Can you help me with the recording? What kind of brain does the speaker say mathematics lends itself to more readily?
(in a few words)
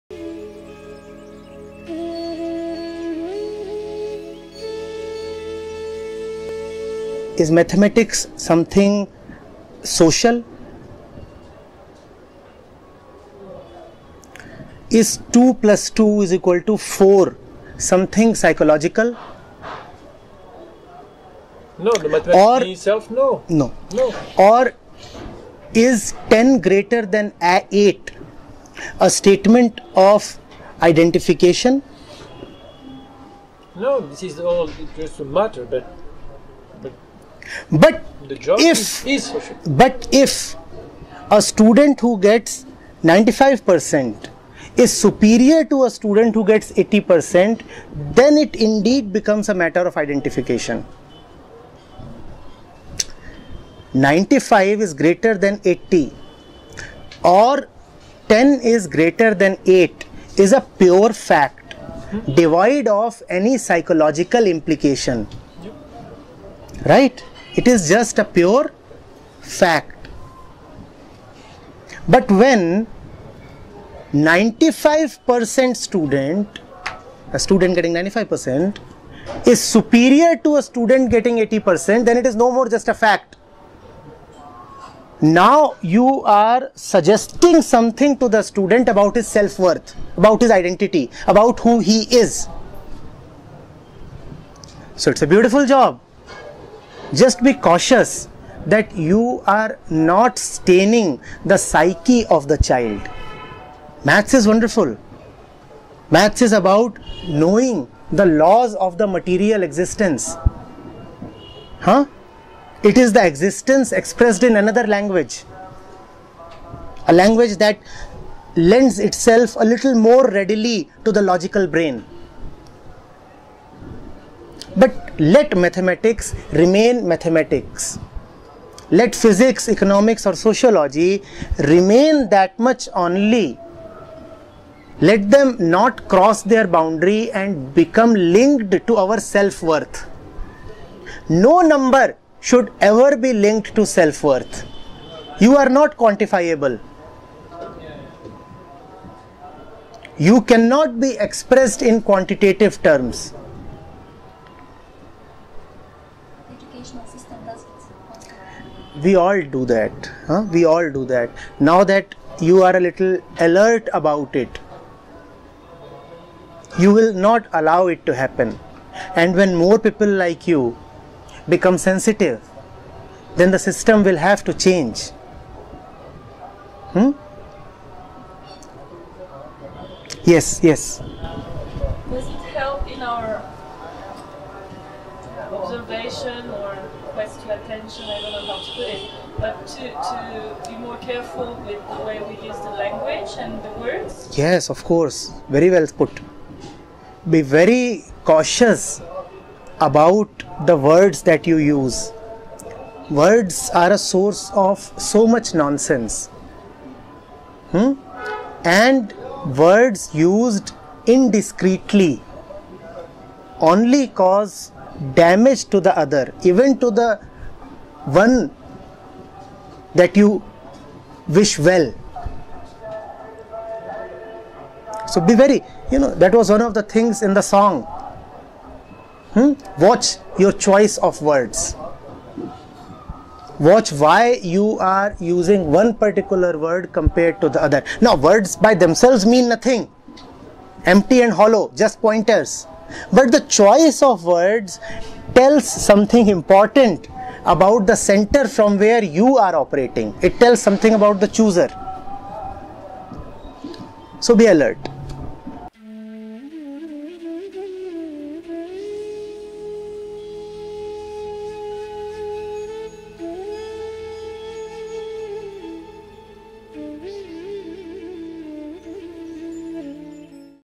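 logical brain.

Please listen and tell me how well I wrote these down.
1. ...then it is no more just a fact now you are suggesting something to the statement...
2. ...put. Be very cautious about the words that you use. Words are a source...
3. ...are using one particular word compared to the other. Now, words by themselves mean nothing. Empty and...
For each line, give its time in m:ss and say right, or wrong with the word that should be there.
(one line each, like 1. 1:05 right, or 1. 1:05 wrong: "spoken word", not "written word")
1. 1:22 wrong: "student", not "statement"
2. 3:15 right
3. 3:54 right.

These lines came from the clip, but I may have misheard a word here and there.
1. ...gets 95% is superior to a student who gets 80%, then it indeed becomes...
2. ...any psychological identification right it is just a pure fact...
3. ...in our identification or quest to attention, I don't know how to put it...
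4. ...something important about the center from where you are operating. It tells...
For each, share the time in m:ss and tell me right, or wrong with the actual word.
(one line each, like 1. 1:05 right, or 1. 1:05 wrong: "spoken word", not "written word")
1. 0:42 right
2. 1:03 wrong: "implication", not "identification"
3. 3:02 wrong: "observation", not "identification"
4. 4:05 right.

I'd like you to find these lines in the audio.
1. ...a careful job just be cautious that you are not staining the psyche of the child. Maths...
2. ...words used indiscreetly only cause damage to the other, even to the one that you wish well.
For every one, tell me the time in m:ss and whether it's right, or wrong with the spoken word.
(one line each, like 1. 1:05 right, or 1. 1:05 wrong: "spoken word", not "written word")
1. 1:35 wrong: "beautiful", not "careful"
2. 3:29 right.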